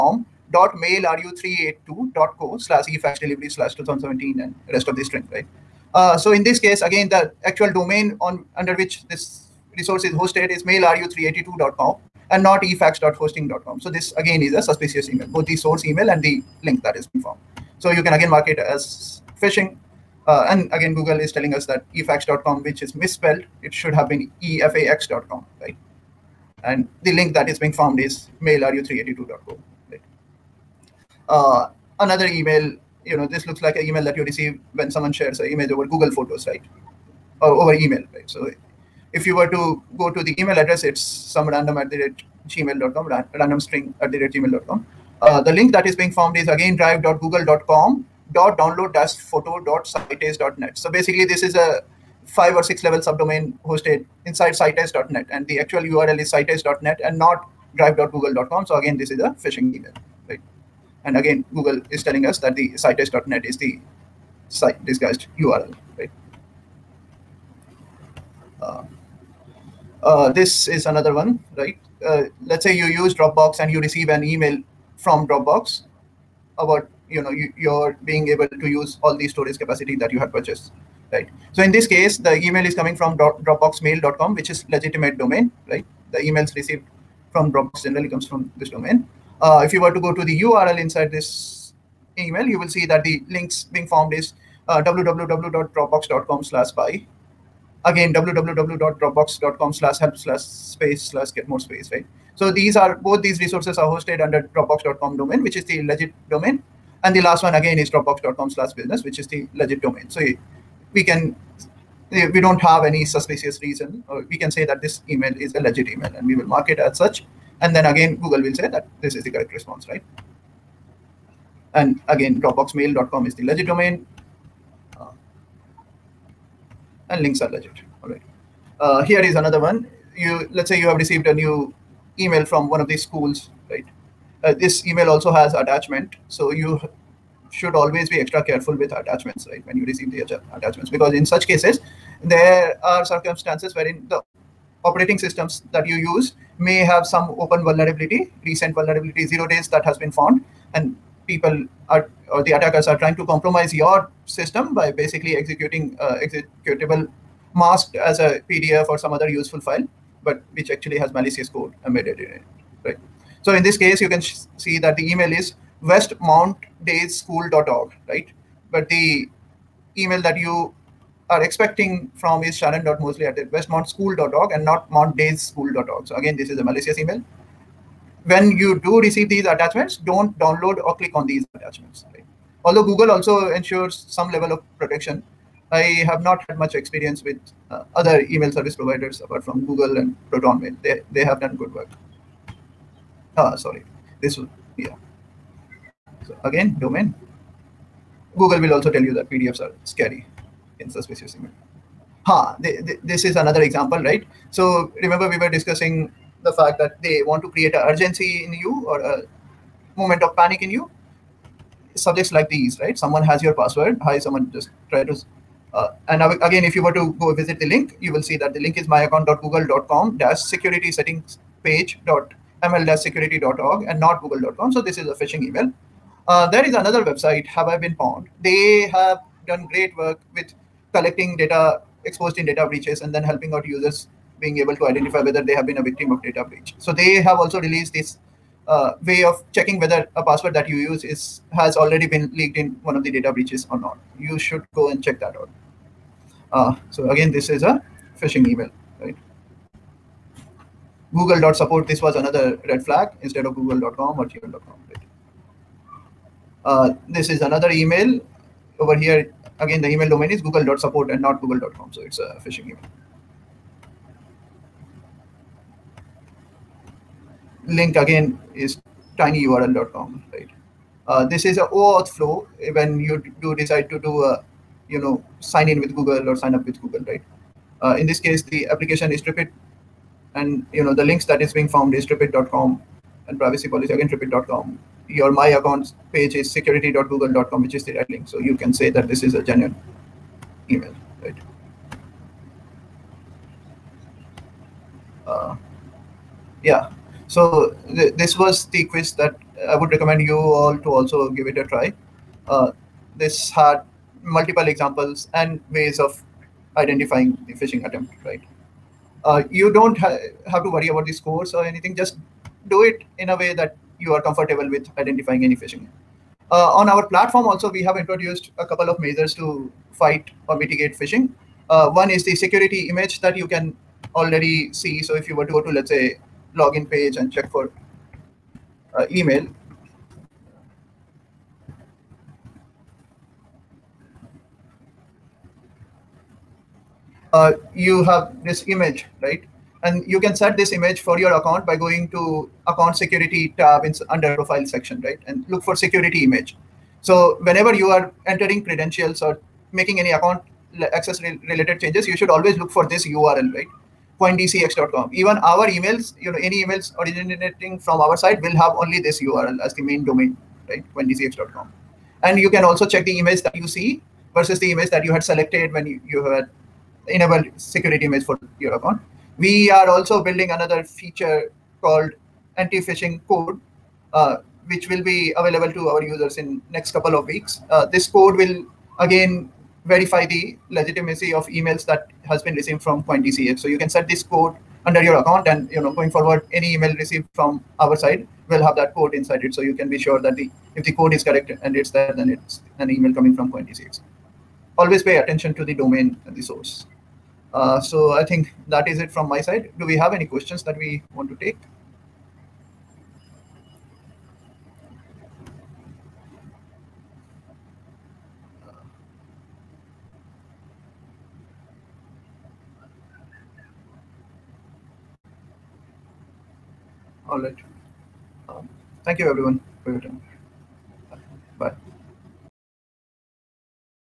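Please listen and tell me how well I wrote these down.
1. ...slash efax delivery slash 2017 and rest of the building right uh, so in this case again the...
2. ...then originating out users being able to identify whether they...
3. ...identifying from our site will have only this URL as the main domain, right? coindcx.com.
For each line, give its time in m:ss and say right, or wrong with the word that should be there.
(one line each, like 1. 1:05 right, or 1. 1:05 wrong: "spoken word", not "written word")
1. 0:02 wrong: "string", not "building"
2. 3:53 wrong: "helping", not "originating"
3. 5:56 wrong: "originating", not "identifying".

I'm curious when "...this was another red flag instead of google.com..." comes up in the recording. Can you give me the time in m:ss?
4:11.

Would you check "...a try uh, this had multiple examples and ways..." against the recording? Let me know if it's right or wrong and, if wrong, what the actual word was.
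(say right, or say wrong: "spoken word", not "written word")
right.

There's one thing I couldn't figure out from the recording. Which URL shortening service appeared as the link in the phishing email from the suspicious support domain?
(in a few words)
tinyurl.com.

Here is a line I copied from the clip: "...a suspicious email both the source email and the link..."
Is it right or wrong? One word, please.
right.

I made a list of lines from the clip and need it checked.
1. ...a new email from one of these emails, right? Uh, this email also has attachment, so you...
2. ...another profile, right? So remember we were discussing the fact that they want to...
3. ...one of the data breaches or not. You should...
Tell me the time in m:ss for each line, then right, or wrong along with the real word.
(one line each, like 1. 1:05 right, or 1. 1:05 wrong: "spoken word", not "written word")
1. 2:11 wrong: "schools", not "emails"
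2. 3:23 wrong: "example", not "profile"
3. 4:02 right.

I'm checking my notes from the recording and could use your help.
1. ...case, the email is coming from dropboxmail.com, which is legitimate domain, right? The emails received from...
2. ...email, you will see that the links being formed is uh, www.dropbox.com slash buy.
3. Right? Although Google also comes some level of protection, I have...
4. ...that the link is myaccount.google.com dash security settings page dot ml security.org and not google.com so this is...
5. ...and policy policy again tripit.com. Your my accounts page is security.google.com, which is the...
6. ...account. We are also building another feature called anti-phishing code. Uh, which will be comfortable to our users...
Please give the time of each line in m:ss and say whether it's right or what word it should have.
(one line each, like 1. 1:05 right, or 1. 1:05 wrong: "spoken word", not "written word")
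1. 1:21 right
2. 1:32 right
3. 3:02 wrong: "ensures", not "comes"
4. 3:38 right
5. 4:43 wrong: "privacy", not "policy"
6. 6:08 wrong: "available", not "comfortable".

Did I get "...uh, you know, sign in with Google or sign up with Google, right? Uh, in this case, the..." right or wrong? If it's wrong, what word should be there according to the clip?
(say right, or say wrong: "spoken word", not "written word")
right.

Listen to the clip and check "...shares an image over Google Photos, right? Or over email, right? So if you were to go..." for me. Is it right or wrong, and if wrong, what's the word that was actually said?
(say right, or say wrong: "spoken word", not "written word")
right.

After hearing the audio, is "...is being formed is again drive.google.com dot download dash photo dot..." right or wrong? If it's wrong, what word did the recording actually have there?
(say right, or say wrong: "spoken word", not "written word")
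right.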